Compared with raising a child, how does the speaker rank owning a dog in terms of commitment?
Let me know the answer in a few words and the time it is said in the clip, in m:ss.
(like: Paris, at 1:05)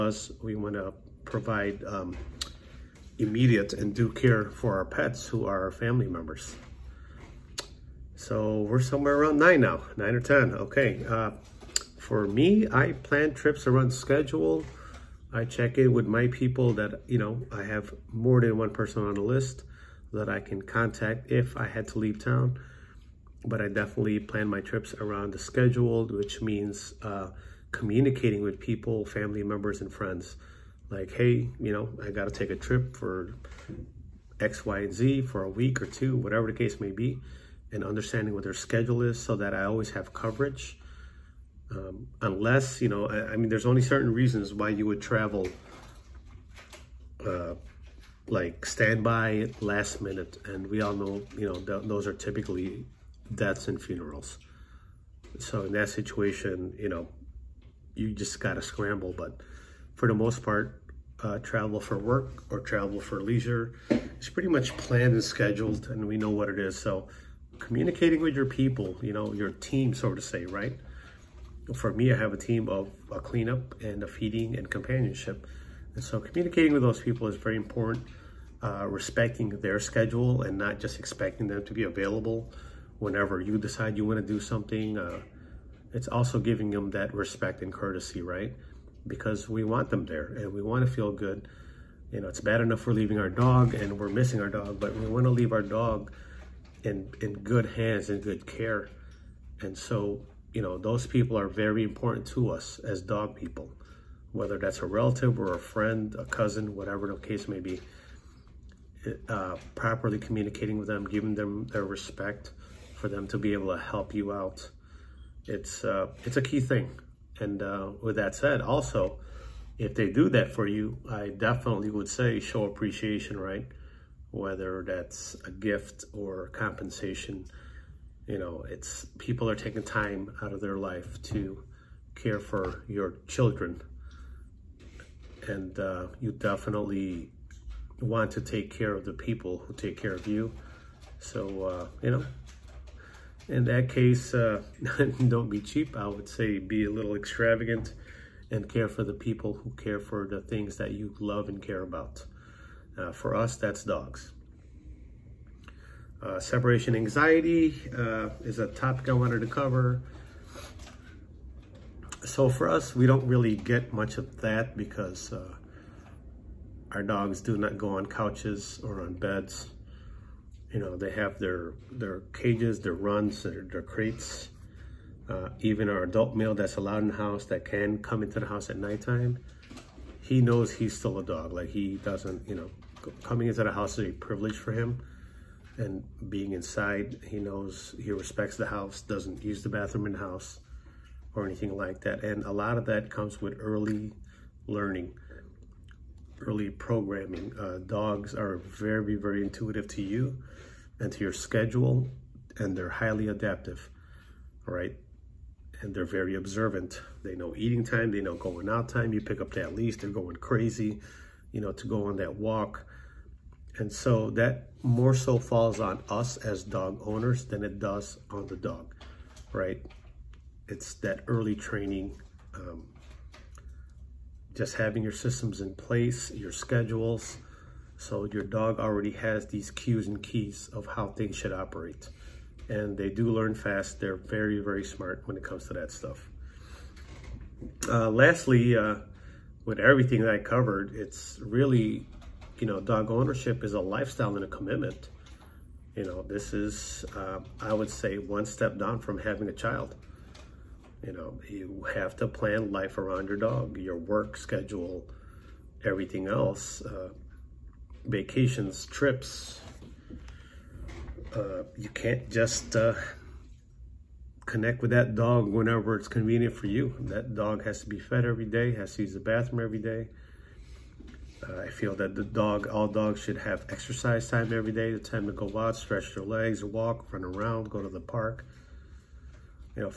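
one step down, at 4:08.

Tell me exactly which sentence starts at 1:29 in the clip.
Because we want them there and we want to feel good.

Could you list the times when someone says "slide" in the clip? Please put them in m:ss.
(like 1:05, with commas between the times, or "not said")
not said.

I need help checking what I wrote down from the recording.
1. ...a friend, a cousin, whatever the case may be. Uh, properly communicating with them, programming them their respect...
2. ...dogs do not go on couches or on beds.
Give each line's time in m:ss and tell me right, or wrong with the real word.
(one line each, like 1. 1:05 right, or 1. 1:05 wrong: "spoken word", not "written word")
1. 1:45 wrong: "giving", not "programming"
2. 2:47 right.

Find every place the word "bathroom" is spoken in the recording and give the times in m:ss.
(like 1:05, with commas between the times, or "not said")
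3:09, 4:29.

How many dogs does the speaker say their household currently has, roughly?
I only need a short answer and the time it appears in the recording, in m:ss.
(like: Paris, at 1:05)
9 or 10, at 0:09.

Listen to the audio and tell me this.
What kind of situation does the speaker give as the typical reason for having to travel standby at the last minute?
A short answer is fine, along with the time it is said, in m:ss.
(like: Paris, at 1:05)
deaths and funerals, at 0:53.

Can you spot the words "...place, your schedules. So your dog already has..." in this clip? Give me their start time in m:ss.
3:45.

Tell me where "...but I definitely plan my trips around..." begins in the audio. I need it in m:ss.
0:23.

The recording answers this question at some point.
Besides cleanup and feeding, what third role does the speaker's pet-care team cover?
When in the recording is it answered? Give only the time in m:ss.
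1:14.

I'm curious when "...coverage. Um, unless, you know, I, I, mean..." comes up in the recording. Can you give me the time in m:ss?
0:40.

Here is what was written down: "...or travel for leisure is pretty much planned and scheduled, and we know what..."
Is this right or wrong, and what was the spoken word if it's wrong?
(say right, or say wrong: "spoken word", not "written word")
right.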